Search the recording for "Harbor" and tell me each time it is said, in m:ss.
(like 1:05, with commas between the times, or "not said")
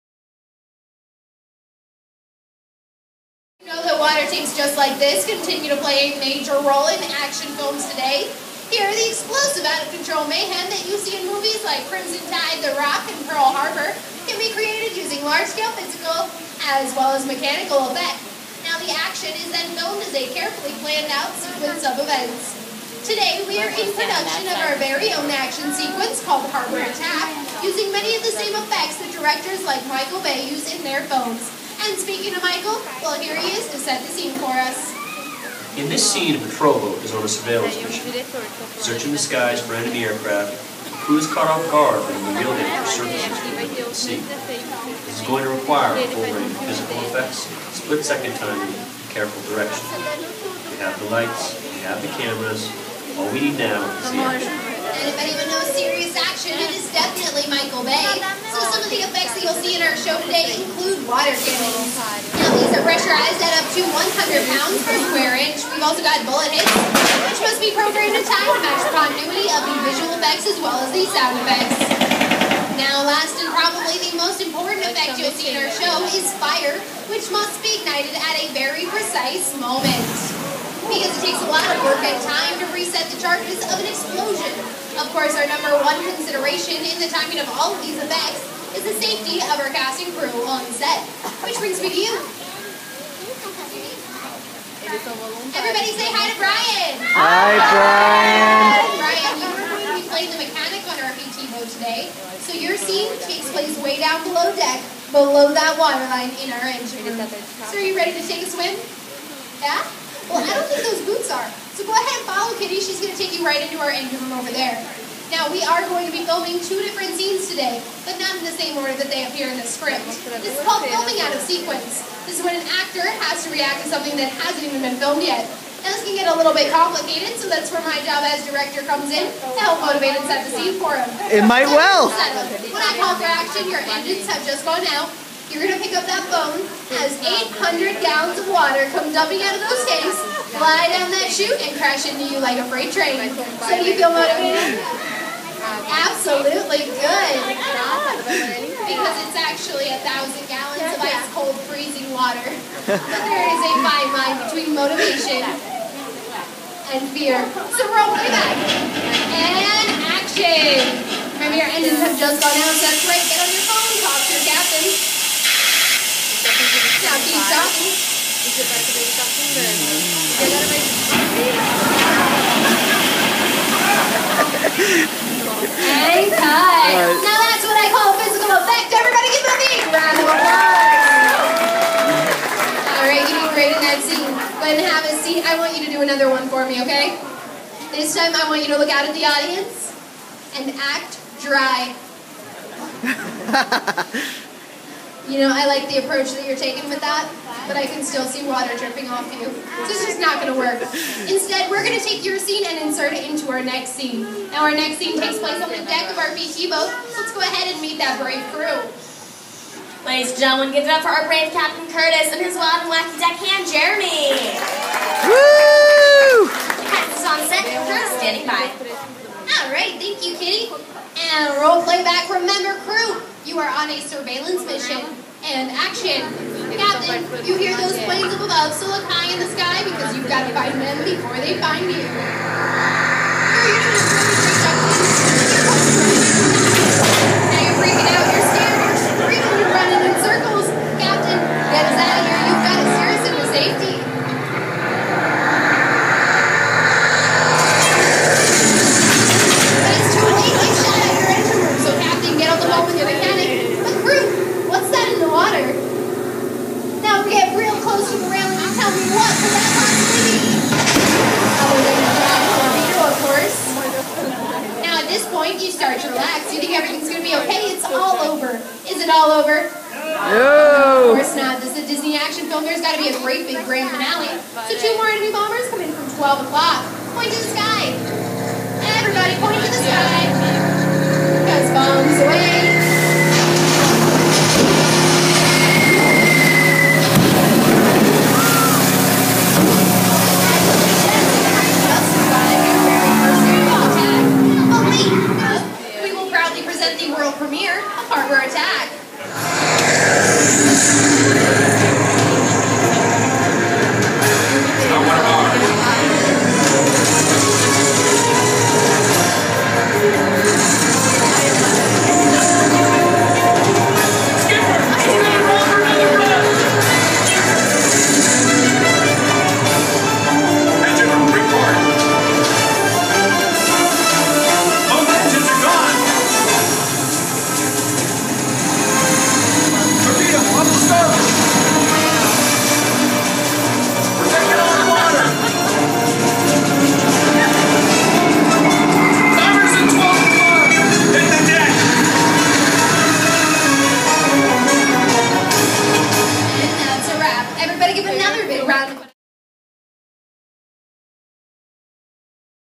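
0:13, 0:26, 4:58.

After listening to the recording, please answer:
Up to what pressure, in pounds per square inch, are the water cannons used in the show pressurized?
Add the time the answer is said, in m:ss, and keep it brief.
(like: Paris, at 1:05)
100, at 1:03.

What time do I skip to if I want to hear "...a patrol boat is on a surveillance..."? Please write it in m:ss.
0:36.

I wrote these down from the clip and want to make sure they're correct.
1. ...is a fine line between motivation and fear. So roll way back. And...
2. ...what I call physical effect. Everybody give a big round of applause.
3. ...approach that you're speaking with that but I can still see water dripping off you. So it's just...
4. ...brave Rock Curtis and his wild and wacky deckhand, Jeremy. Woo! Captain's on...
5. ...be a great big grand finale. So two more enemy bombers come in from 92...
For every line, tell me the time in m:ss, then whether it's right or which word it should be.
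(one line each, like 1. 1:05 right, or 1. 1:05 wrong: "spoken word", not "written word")
1. 2:33 right
2. 2:57 right
3. 3:16 wrong: "taking", not "speaking"
4. 3:31 wrong: "Captain", not "Rock"
5. 4:33 wrong: "12", not "92".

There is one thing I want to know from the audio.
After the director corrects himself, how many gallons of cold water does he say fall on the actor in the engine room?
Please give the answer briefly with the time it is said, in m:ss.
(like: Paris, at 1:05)
1,000, at 2:29.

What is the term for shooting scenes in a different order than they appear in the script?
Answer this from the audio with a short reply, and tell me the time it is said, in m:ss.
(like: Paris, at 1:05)
filming out of sequence, at 2:00.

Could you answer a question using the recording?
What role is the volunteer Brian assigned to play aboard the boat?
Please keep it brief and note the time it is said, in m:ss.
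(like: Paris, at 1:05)
the mechanic, at 1:40.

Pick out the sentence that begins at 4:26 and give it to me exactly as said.
You think everything's going to be okay.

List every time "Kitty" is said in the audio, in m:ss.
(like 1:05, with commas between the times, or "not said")
1:52, 3:40.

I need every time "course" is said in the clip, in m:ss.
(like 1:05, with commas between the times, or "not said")
1:25, 4:31.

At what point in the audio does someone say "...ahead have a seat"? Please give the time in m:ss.
3:04.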